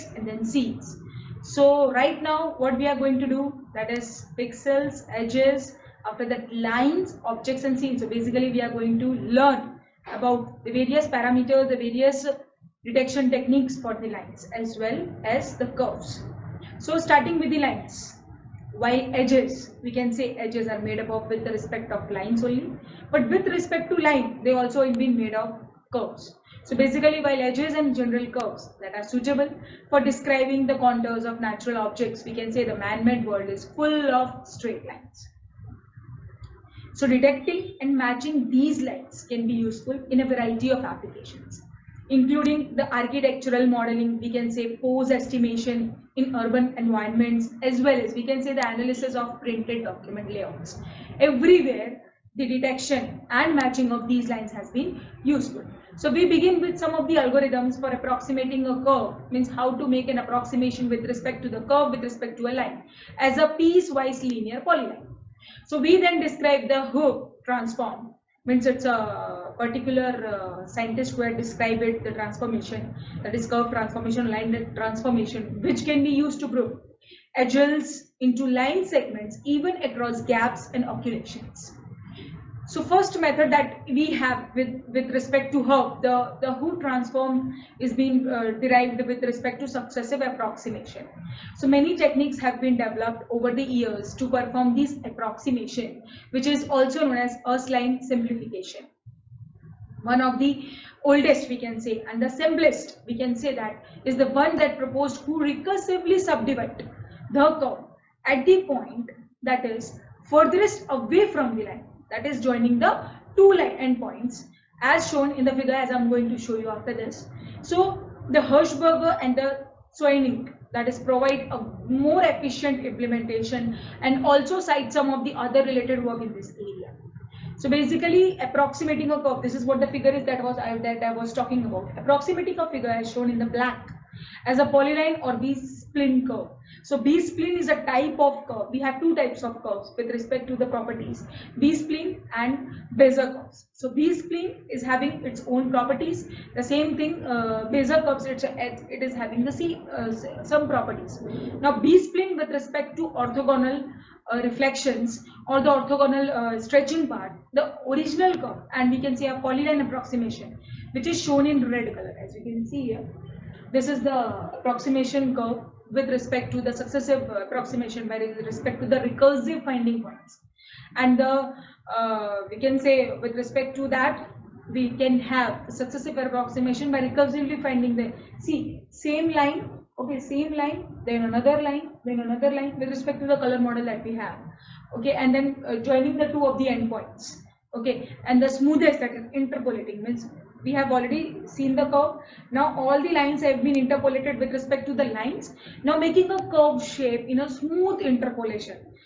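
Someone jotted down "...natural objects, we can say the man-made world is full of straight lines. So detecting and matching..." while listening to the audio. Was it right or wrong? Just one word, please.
right.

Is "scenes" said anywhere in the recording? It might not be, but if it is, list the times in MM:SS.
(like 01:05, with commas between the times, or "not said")
00:00, 00:07.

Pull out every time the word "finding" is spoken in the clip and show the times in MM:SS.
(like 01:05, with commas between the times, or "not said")
02:49, 02:57.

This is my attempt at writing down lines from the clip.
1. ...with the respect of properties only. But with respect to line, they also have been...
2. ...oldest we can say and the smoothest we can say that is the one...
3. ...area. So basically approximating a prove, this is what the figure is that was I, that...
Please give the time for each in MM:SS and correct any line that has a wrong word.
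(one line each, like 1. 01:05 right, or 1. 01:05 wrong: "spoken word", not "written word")
1. 00:21 wrong: "lines", not "properties"
2. 01:41 wrong: "simplest", not "smoothest"
3. 02:06 wrong: "curve", not "prove".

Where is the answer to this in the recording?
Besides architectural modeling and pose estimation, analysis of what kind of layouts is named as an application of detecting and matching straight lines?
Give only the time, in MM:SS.
00:49.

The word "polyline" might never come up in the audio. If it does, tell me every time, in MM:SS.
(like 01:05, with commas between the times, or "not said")
01:04, 02:14, 02:39.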